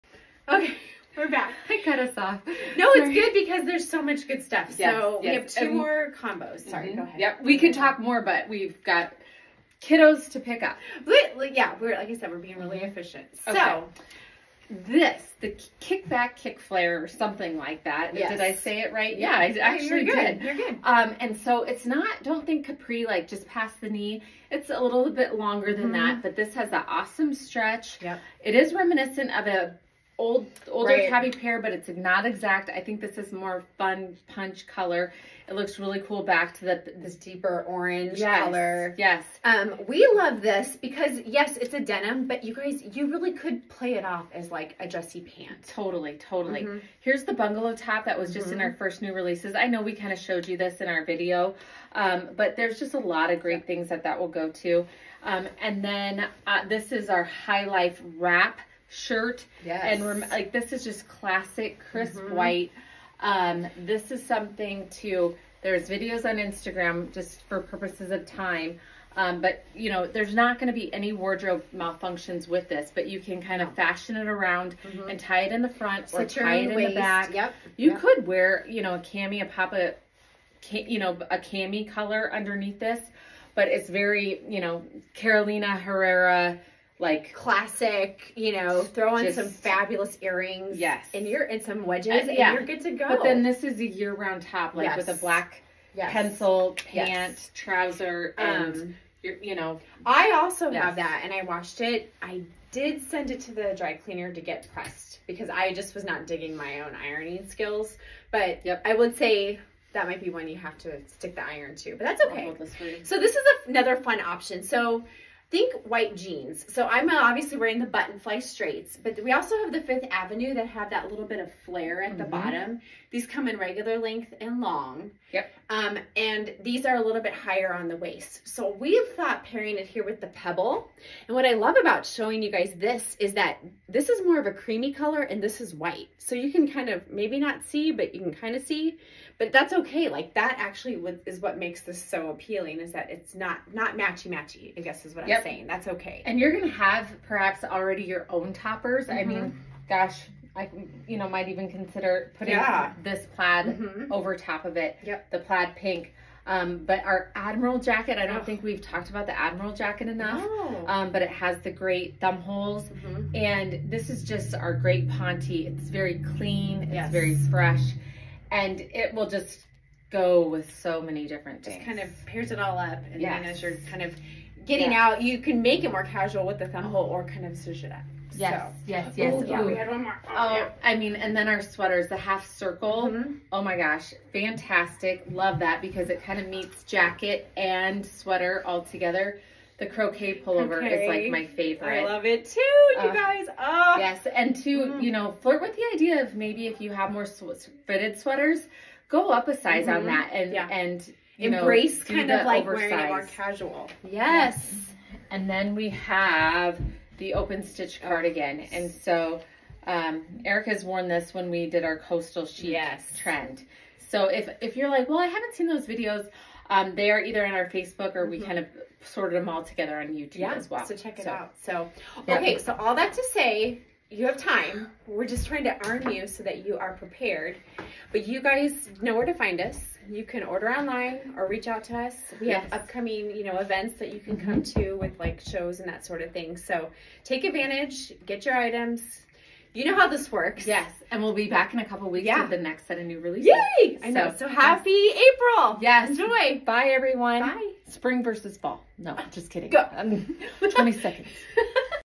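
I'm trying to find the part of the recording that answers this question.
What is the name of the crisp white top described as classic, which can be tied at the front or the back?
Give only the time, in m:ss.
0:57.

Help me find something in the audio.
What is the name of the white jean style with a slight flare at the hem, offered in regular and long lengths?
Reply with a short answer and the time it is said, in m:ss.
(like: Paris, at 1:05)
Fifth Avenue, at 1:59.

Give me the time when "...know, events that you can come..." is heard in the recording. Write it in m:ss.
3:53.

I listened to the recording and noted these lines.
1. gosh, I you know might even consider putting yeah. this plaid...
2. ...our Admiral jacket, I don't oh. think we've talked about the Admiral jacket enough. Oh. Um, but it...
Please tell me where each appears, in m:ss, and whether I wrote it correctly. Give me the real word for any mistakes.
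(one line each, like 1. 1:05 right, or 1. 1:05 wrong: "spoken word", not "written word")
1. 2:29 right
2. 2:37 right.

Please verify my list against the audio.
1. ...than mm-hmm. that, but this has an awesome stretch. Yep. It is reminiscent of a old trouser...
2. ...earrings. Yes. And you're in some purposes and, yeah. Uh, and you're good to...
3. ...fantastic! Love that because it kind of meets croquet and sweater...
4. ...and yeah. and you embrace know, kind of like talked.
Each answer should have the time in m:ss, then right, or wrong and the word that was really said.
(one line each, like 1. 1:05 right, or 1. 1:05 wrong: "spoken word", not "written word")
1. 0:25 wrong: "older", not "trouser"
2. 1:30 wrong: "wedges", not "purposes"
3. 3:04 wrong: "jacket", not "croquet"
4. 3:20 wrong: "oversized", not "talked".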